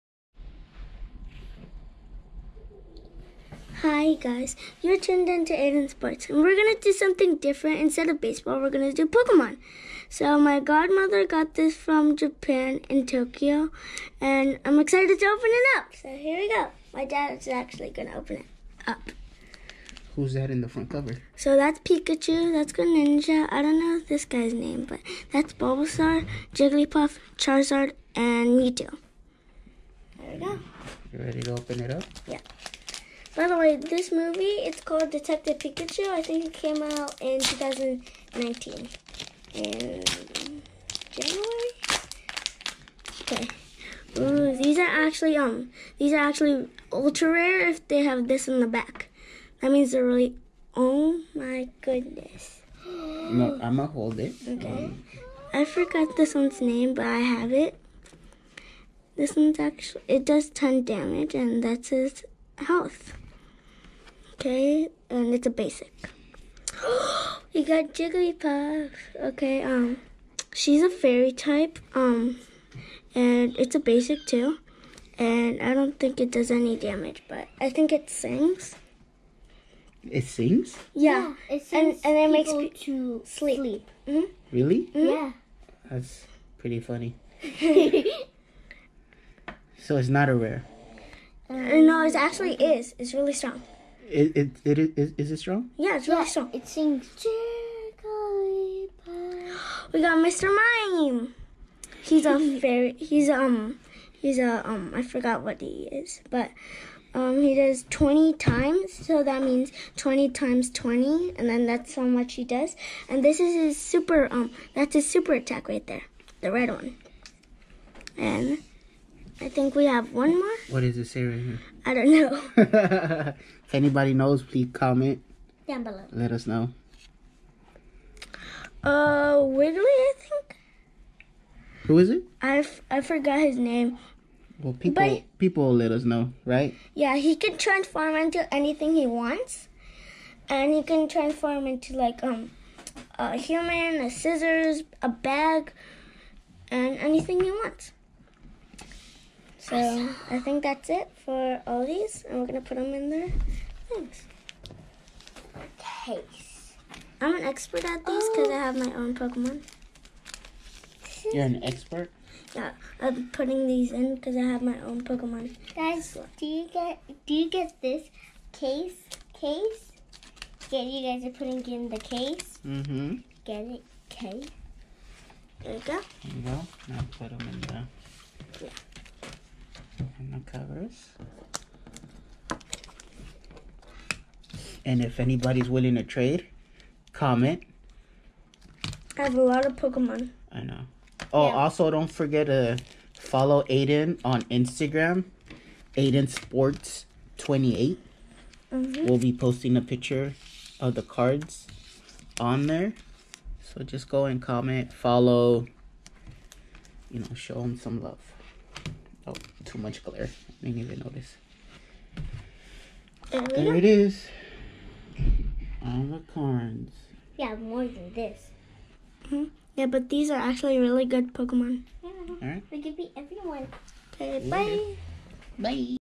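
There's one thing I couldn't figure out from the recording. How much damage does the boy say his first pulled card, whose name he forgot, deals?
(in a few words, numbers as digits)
10.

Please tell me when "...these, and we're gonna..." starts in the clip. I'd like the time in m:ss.
2:31.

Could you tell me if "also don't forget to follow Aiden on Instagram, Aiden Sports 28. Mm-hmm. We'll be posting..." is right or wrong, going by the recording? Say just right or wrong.
right.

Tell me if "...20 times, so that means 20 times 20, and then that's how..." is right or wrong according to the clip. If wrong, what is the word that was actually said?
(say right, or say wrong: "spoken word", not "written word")
right.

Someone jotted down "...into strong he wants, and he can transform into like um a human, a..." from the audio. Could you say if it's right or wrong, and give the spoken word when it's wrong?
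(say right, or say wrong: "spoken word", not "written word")
wrong: "anything", not "strong".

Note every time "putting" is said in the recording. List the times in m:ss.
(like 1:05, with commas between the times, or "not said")
2:43, 2:51.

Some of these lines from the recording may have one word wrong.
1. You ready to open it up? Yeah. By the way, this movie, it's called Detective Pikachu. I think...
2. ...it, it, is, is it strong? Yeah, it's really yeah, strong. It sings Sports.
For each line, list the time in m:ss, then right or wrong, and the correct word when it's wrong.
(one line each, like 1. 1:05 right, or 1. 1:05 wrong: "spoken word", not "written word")
1. 0:31 right
2. 1:34 wrong: "Jigglypuff", not "Sports".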